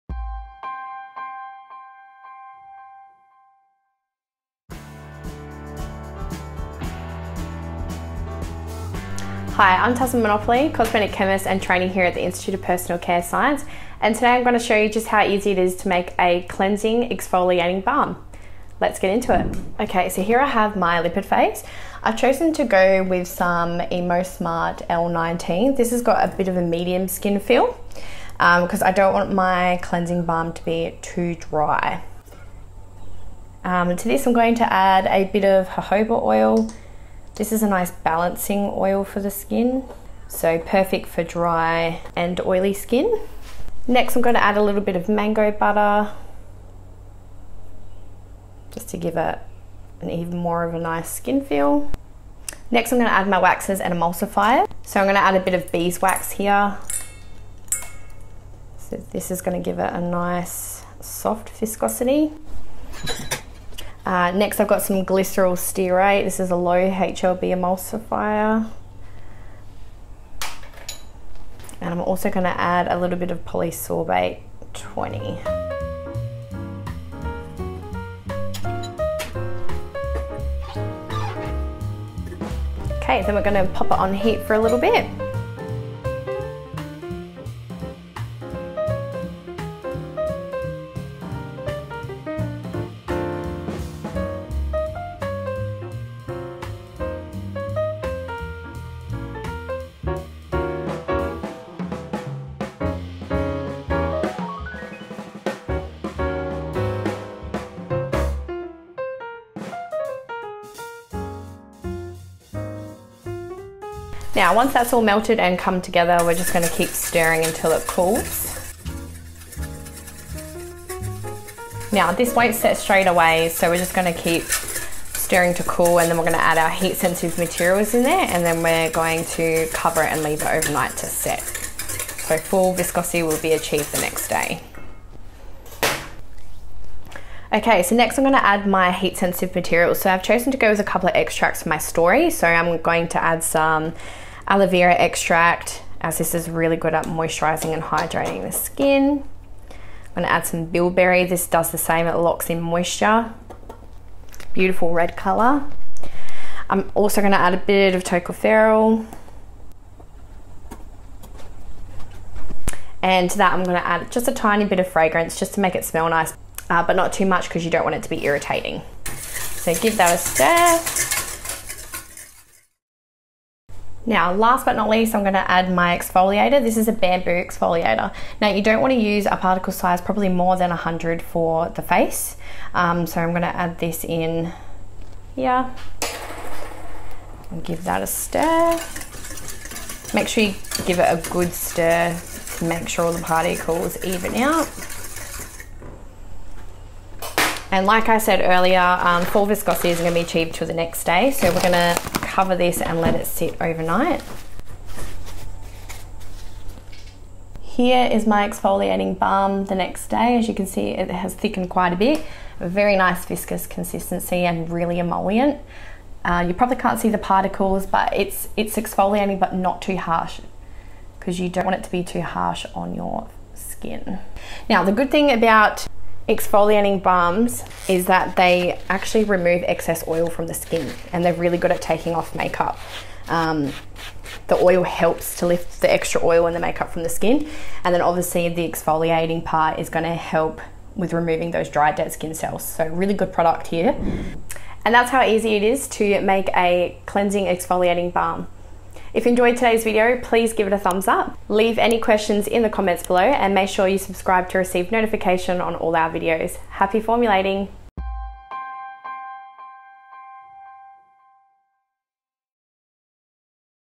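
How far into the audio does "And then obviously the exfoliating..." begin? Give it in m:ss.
3:57.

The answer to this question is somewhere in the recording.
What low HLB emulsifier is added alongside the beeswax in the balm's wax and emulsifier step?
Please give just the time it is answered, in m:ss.
1:05.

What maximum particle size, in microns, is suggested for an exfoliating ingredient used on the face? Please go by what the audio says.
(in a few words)
100.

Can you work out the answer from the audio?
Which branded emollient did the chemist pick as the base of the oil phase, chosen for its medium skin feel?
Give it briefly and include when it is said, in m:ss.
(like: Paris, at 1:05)
EmoSmart L19, at 0:23.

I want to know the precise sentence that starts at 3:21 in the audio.
So we're going to cover this and let it sit overnight.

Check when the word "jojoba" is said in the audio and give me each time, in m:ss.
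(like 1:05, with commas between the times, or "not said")
0:35.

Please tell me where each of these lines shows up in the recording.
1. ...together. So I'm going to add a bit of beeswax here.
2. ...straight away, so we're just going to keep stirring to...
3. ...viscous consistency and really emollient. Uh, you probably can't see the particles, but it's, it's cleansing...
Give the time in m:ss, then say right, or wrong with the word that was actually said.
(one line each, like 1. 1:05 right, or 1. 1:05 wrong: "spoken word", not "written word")
1. 0:53 wrong: "emulsifier", not "together"
2. 2:02 right
3. 3:33 wrong: "exfoliating", not "cleansing".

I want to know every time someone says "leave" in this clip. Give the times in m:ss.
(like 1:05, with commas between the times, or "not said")
2:10, 4:11.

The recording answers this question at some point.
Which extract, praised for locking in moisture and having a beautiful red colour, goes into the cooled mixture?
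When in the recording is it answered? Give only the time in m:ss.
2:30.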